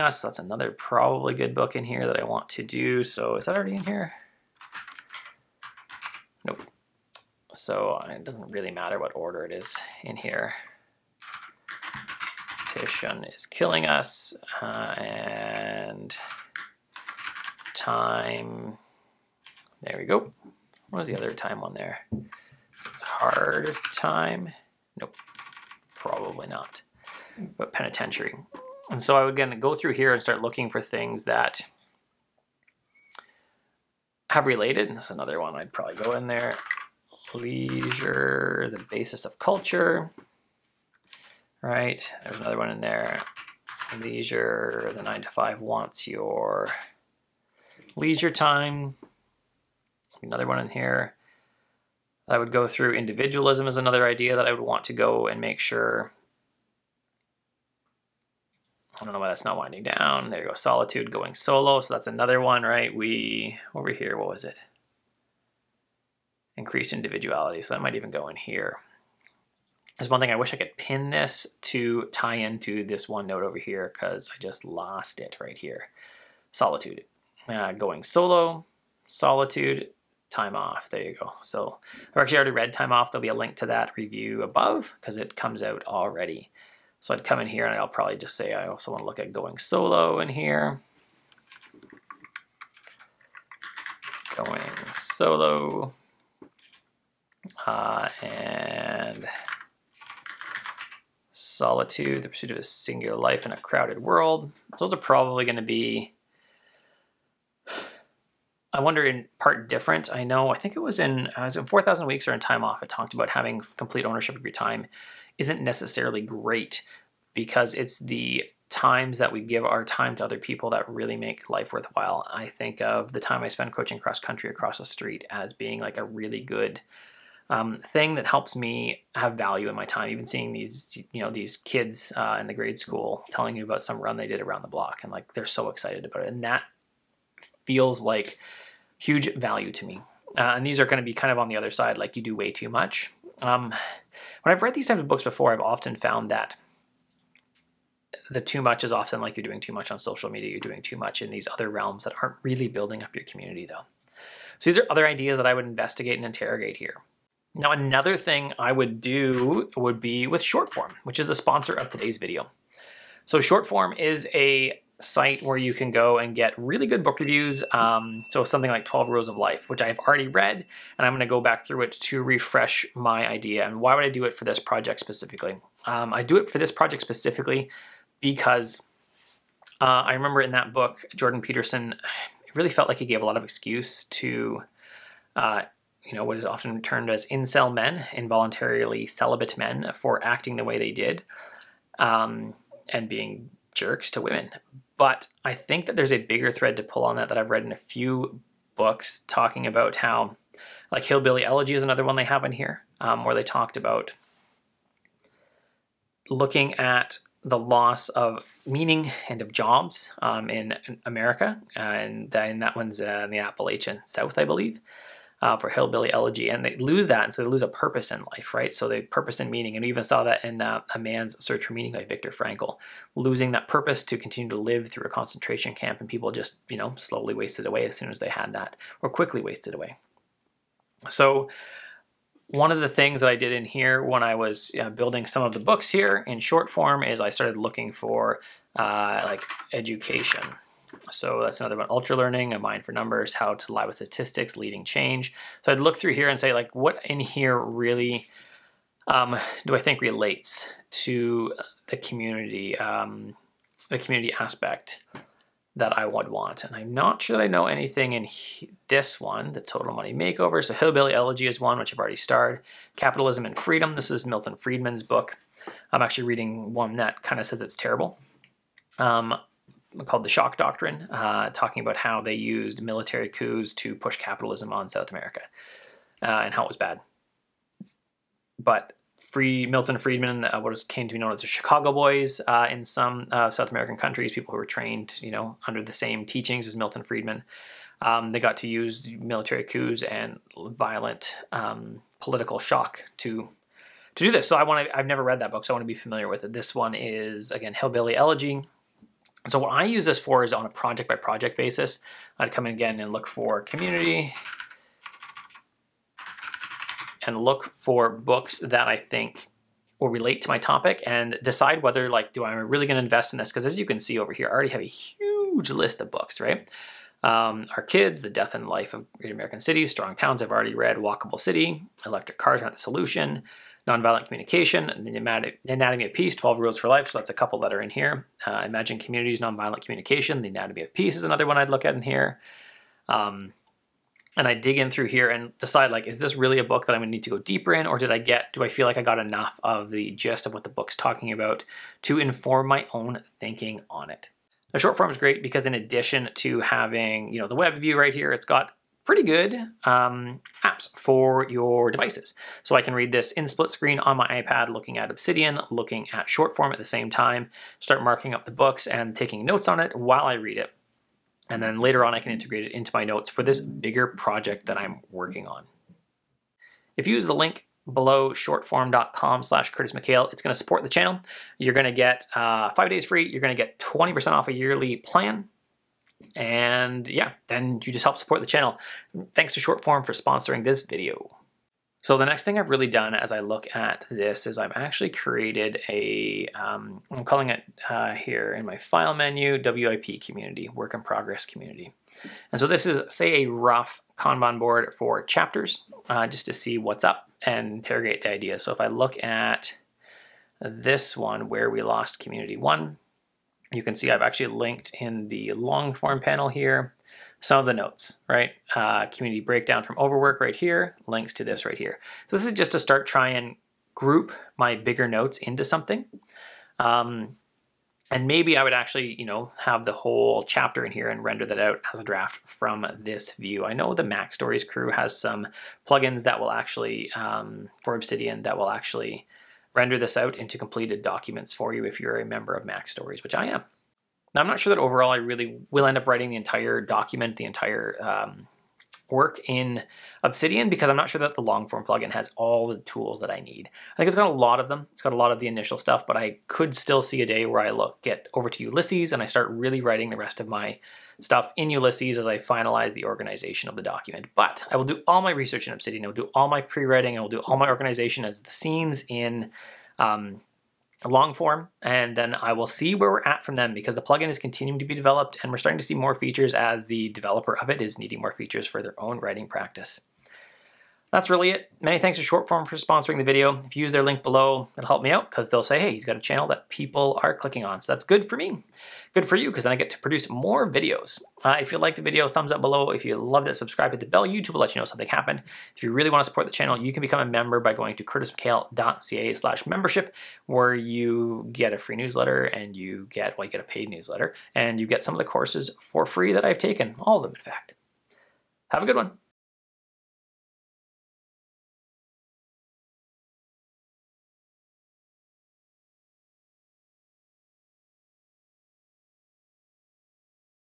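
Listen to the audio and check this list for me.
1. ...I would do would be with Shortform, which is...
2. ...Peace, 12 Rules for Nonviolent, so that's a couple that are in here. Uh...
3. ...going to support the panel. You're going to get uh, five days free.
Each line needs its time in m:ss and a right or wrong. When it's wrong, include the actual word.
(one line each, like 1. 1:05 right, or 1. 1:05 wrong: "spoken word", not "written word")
1. 2:38 right
2. 5:26 wrong: "Life", not "Nonviolent"
3. 6:10 wrong: "channel", not "panel".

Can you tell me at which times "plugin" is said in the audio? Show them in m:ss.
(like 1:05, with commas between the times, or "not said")
7:05, 7:21, 7:44.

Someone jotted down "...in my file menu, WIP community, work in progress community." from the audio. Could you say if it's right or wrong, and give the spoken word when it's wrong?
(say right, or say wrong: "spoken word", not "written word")
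right.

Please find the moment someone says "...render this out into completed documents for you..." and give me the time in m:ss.
7:09.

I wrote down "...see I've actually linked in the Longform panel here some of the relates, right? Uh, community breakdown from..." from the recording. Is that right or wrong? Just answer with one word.
wrong.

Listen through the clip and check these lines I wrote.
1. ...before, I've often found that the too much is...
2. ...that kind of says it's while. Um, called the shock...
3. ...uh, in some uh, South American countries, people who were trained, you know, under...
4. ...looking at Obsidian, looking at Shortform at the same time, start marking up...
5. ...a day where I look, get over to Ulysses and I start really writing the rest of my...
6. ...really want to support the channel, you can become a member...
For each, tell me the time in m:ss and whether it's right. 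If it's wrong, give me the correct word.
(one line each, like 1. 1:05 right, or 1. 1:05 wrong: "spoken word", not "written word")
1. 2:25 right
2. 4:26 wrong: "terrible", not "while"
3. 4:42 right
4. 5:54 right
5. 7:27 right
6. 8:05 right.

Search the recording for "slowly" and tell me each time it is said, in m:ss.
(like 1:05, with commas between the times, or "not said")
3:46.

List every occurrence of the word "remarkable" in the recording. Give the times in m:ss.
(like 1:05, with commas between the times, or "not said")
not said.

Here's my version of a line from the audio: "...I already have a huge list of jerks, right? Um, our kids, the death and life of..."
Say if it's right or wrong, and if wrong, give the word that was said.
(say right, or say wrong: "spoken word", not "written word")
wrong: "books", not "jerks".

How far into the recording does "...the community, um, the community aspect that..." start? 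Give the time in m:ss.
4:11.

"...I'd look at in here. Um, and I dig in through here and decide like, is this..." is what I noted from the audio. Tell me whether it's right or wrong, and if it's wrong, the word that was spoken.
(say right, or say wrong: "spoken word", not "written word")
right.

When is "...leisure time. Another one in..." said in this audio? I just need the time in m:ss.
0:47.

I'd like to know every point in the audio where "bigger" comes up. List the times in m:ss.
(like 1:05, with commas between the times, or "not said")
3:16, 6:03, 6:54.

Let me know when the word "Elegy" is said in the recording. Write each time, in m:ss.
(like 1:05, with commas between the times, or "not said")
3:21, 3:36, 4:21, 4:58.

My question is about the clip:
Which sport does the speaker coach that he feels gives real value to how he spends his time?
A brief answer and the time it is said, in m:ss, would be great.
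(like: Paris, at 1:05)
Cross country, at 2:03.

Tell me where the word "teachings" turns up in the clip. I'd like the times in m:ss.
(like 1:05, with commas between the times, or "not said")
4:46.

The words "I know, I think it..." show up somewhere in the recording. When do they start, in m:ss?
1:50.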